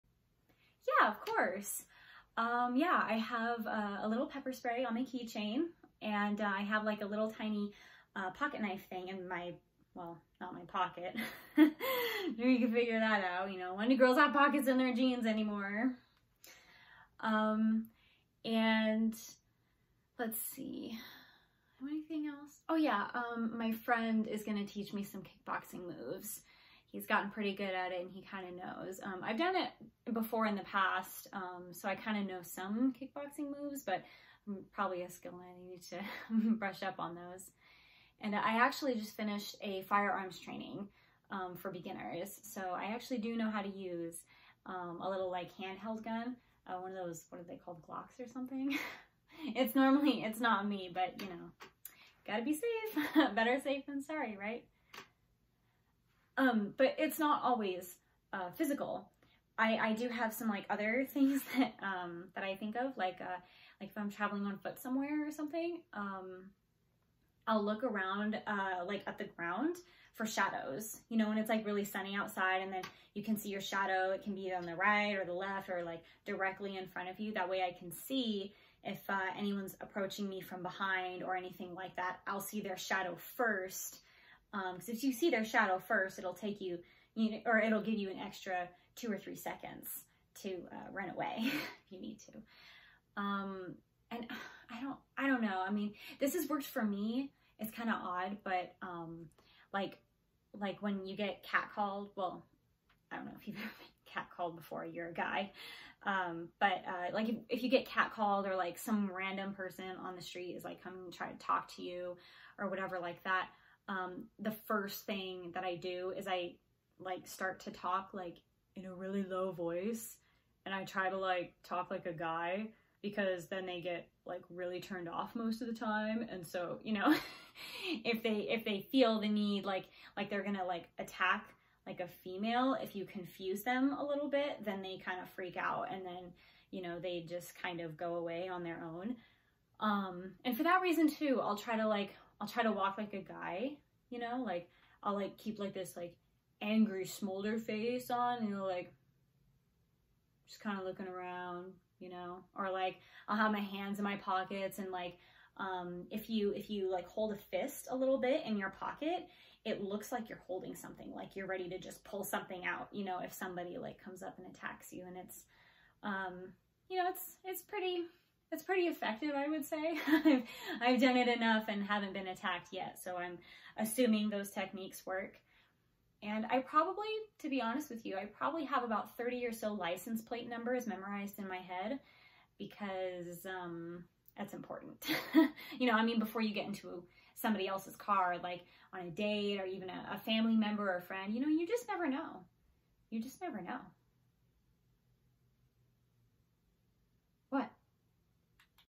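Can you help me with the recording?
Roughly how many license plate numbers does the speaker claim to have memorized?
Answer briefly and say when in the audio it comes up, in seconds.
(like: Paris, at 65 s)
30, at 179 s.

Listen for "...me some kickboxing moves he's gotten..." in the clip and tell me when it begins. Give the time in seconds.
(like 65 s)
24 s.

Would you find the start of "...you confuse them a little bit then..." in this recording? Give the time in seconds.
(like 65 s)
132 s.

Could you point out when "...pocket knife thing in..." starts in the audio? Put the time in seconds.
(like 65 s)
8 s.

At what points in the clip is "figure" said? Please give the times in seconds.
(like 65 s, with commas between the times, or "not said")
12 s.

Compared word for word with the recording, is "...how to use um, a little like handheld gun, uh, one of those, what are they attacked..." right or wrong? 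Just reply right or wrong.
wrong.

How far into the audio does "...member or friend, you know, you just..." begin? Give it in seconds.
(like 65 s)
190 s.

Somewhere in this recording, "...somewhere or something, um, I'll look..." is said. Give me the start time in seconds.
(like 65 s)
64 s.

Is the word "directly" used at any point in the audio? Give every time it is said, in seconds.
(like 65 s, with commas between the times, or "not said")
76 s.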